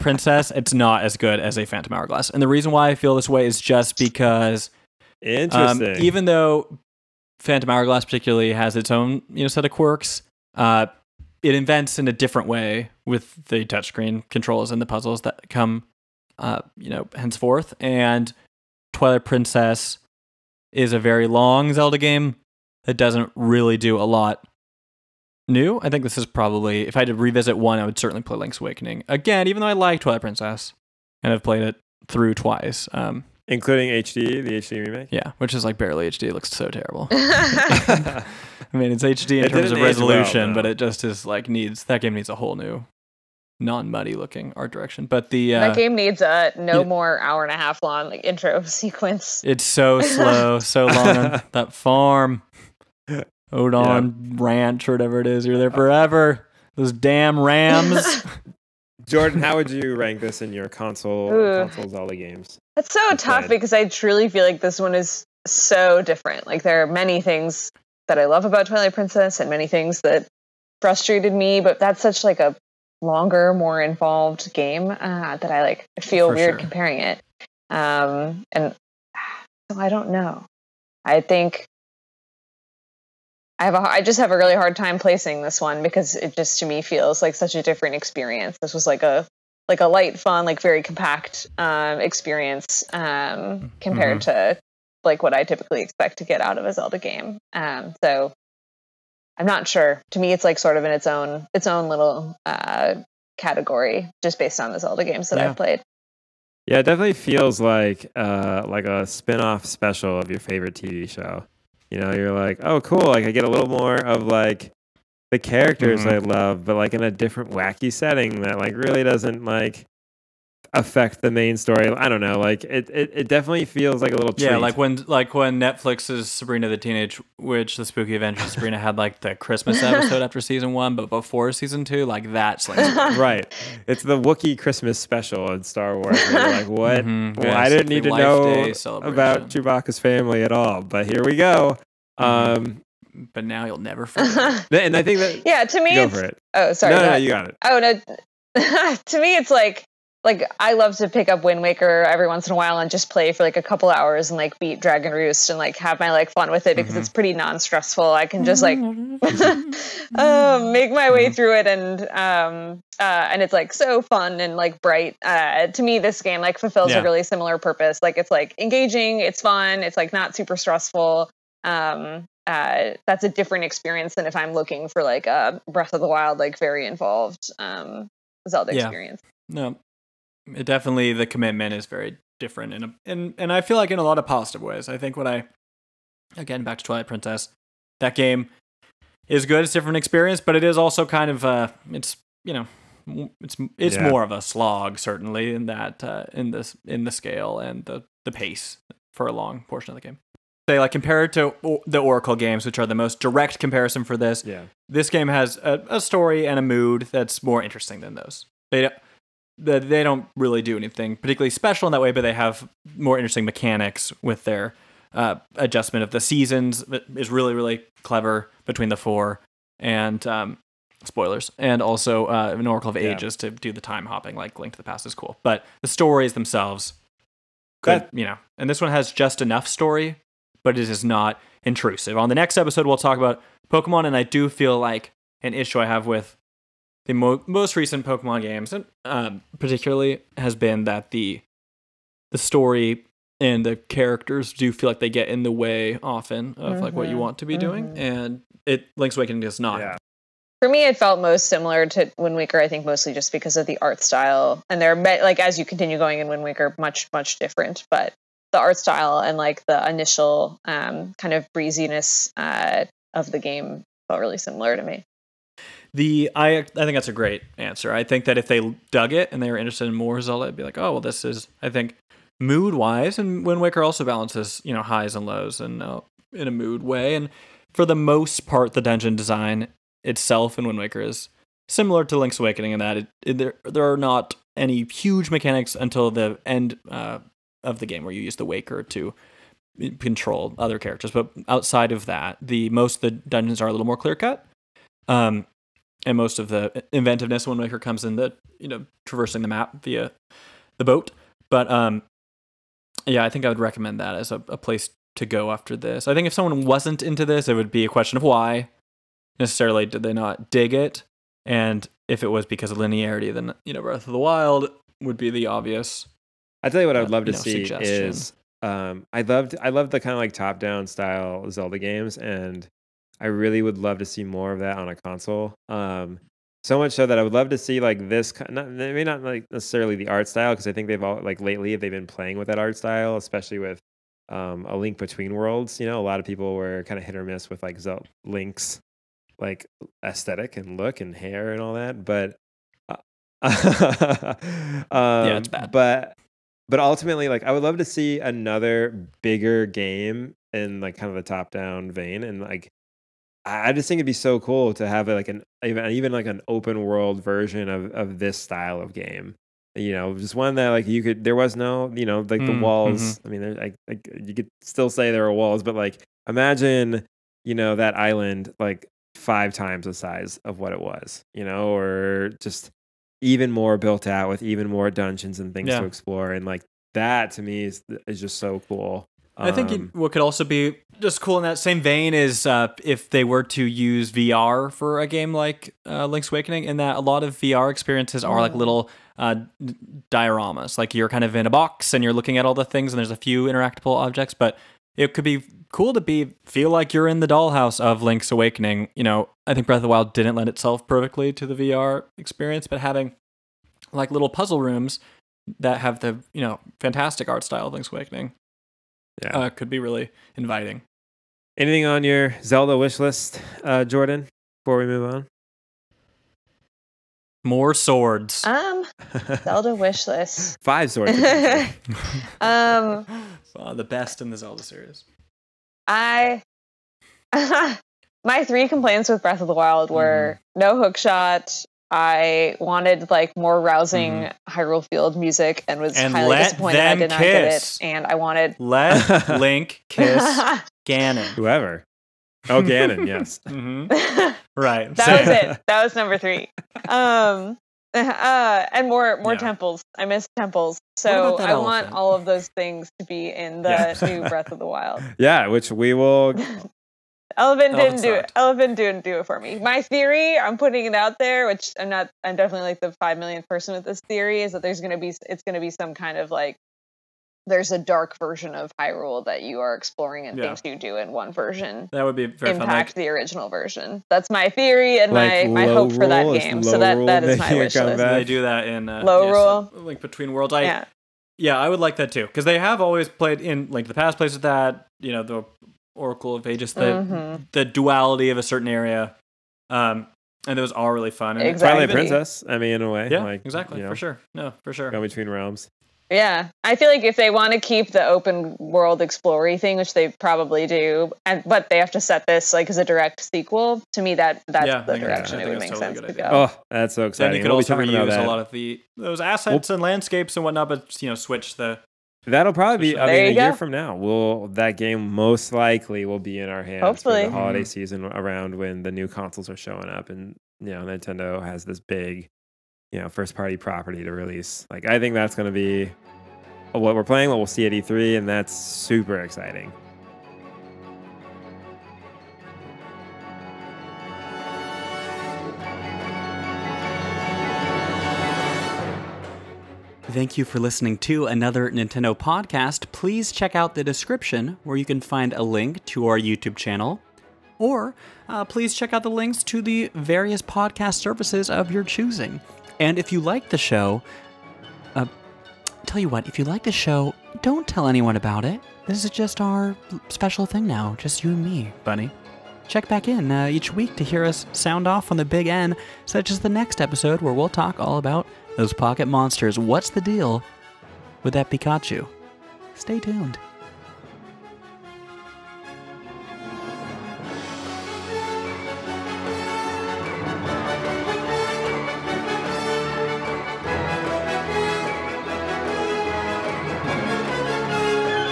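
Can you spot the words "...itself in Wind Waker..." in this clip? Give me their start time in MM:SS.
04:40.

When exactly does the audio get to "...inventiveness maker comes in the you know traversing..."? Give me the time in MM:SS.
04:56.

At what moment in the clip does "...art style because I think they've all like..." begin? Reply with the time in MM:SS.
05:30.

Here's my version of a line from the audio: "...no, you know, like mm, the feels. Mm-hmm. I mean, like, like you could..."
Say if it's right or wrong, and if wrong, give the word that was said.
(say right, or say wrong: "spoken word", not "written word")
wrong: "walls", not "feels".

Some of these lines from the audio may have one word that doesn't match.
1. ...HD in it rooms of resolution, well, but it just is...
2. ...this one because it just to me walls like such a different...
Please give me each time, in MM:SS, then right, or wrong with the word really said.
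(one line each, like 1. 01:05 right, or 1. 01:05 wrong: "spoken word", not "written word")
1. 00:39 wrong: "terms", not "rooms"
2. 01:25 wrong: "feels", not "walls".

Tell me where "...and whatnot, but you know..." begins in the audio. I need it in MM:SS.
08:30.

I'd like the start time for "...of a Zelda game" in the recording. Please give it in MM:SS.
01:36.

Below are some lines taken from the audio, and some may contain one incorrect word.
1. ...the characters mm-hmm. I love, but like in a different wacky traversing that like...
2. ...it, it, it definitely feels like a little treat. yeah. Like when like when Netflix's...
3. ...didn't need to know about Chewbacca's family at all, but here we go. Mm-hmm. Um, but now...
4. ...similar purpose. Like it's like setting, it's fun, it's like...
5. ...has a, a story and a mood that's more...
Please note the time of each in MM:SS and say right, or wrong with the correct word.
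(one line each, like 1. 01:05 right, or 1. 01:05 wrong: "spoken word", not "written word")
1. 01:55 wrong: "setting", not "traversing"
2. 02:02 right
3. 02:17 right
4. 02:47 wrong: "engaging", not "setting"
5. 03:25 right.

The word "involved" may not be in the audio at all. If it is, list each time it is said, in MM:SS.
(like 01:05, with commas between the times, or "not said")
01:13, 02:56.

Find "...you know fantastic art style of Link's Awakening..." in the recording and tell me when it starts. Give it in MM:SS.
06:46.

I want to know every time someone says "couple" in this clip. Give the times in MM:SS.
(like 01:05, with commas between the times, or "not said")
02:33.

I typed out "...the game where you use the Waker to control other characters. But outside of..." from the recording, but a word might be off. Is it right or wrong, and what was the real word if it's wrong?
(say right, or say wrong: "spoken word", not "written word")
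right.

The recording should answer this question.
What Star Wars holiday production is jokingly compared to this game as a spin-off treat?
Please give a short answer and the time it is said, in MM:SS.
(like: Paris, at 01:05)
Wookiee Christmas special, at 02:14.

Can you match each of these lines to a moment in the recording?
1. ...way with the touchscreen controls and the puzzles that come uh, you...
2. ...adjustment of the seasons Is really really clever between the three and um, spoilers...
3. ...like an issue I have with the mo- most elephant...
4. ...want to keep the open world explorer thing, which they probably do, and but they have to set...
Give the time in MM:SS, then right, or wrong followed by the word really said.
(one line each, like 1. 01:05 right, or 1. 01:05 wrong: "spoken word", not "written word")
1. 00:12 right
2. 03:35 wrong: "four", not "three"
3. 03:54 wrong: "recent", not "elephant"
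4. 08:17 right.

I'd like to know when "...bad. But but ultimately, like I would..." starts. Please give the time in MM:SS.
05:45.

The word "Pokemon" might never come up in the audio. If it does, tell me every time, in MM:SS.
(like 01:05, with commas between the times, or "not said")
03:53, 03:58.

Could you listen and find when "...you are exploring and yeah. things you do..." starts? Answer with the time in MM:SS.
07:49.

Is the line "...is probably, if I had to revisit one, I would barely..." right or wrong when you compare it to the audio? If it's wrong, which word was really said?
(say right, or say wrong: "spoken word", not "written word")
wrong: "certainly", not "barely".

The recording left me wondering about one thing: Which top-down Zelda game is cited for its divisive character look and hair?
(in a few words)
A Link Between Worlds.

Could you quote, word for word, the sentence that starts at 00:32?
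Um, Including HD, the HD remake?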